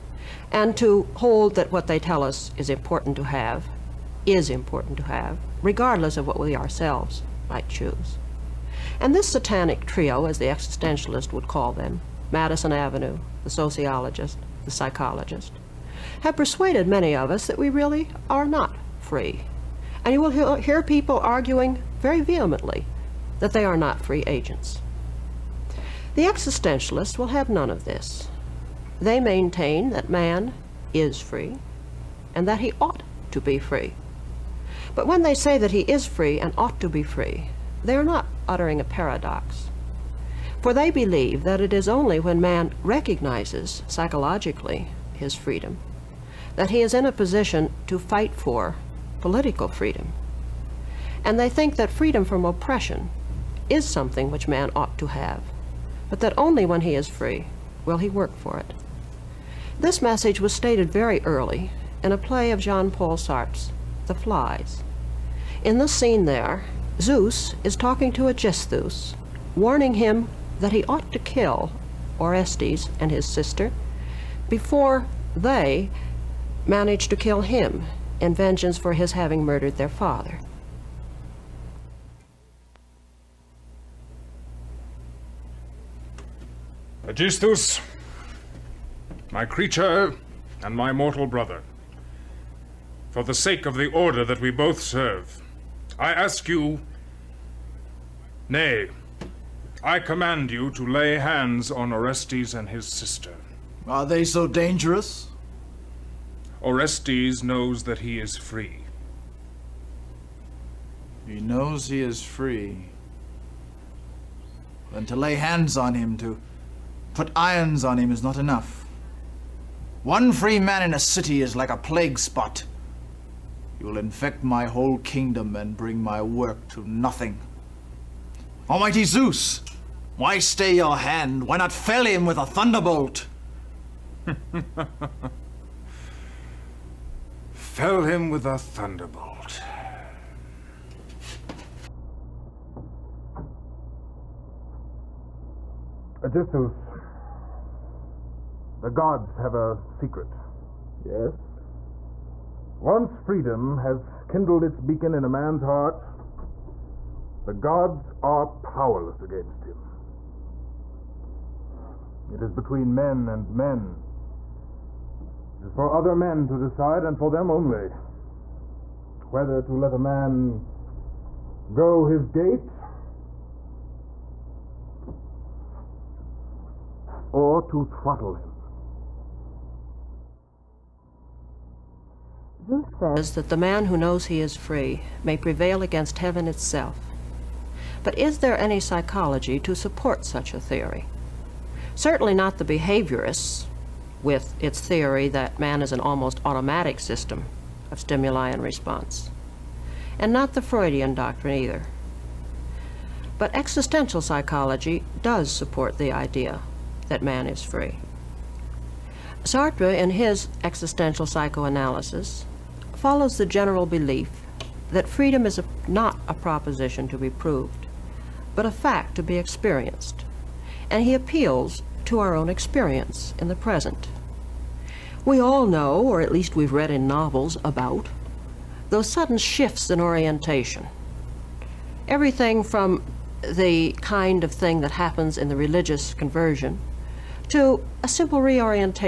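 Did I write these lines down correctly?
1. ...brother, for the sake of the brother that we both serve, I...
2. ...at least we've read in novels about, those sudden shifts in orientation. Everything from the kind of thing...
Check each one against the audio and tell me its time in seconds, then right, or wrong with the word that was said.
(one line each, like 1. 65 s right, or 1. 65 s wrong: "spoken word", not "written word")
1. 91 s wrong: "order", not "brother"
2. 226 s right.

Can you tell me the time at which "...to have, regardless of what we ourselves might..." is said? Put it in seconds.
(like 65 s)
4 s.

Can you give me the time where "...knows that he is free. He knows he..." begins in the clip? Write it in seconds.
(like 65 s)
107 s.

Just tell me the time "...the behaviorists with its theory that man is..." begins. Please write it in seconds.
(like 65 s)
192 s.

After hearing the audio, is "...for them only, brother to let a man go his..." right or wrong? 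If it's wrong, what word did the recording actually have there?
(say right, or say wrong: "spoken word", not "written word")
wrong: "whether", not "brother".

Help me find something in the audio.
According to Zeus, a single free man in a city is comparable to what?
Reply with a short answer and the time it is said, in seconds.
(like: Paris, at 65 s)
A plague spot, at 121 s.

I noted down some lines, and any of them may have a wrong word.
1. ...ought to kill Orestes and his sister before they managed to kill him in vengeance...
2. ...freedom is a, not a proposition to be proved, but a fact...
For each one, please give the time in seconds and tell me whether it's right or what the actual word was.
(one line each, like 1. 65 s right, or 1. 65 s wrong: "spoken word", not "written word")
1. 70 s right
2. 215 s right.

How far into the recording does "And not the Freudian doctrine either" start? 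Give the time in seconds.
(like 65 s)
200 s.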